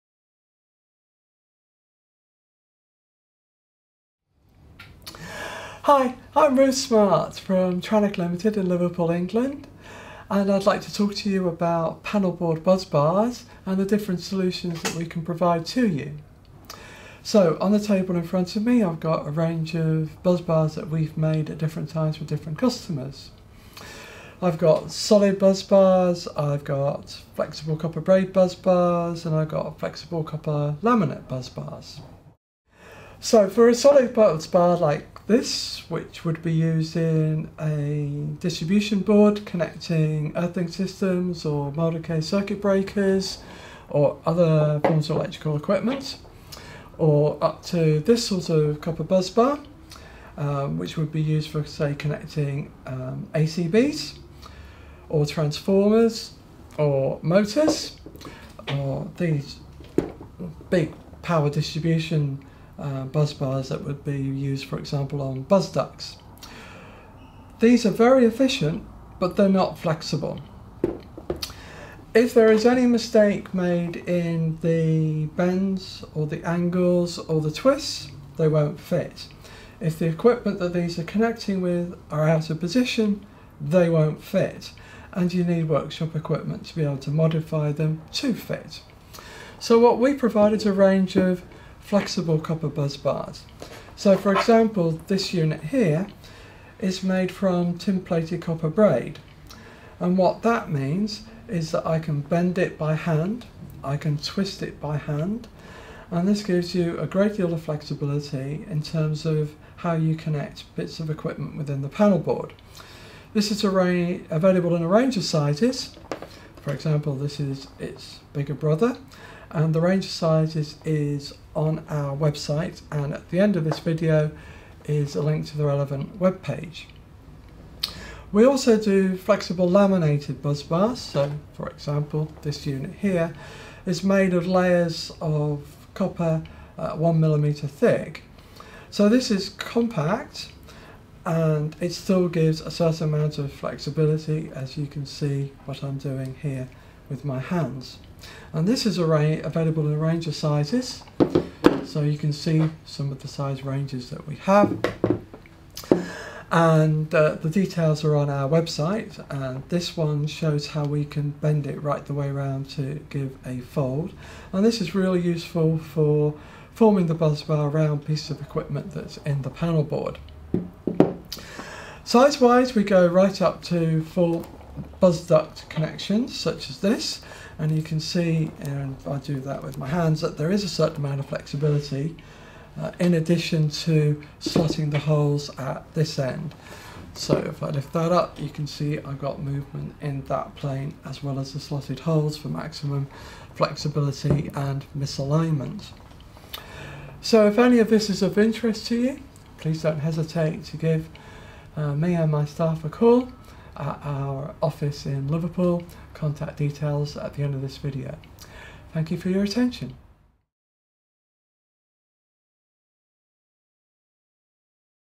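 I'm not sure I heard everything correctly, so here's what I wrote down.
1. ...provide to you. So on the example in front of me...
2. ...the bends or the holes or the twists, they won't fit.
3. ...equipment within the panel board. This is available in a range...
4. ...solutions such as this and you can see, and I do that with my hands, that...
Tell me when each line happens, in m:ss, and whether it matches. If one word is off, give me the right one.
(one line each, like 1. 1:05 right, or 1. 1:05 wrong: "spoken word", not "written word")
1. 0:15 wrong: "table", not "example"
2. 1:14 wrong: "angles", not "holes"
3. 1:51 right
4. 2:55 wrong: "connections", not "solutions".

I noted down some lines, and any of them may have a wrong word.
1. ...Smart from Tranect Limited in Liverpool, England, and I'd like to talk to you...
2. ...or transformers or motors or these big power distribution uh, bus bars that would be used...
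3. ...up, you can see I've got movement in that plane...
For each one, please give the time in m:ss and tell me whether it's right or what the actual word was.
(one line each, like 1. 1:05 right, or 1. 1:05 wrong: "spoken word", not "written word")
1. 0:06 right
2. 0:55 right
3. 3:08 right.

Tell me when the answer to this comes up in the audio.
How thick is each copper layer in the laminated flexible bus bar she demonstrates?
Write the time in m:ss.
2:16.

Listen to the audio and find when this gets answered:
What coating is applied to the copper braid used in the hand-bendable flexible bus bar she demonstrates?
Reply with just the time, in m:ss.
1:37.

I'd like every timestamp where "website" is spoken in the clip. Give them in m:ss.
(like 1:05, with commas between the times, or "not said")
2:02, 2:38.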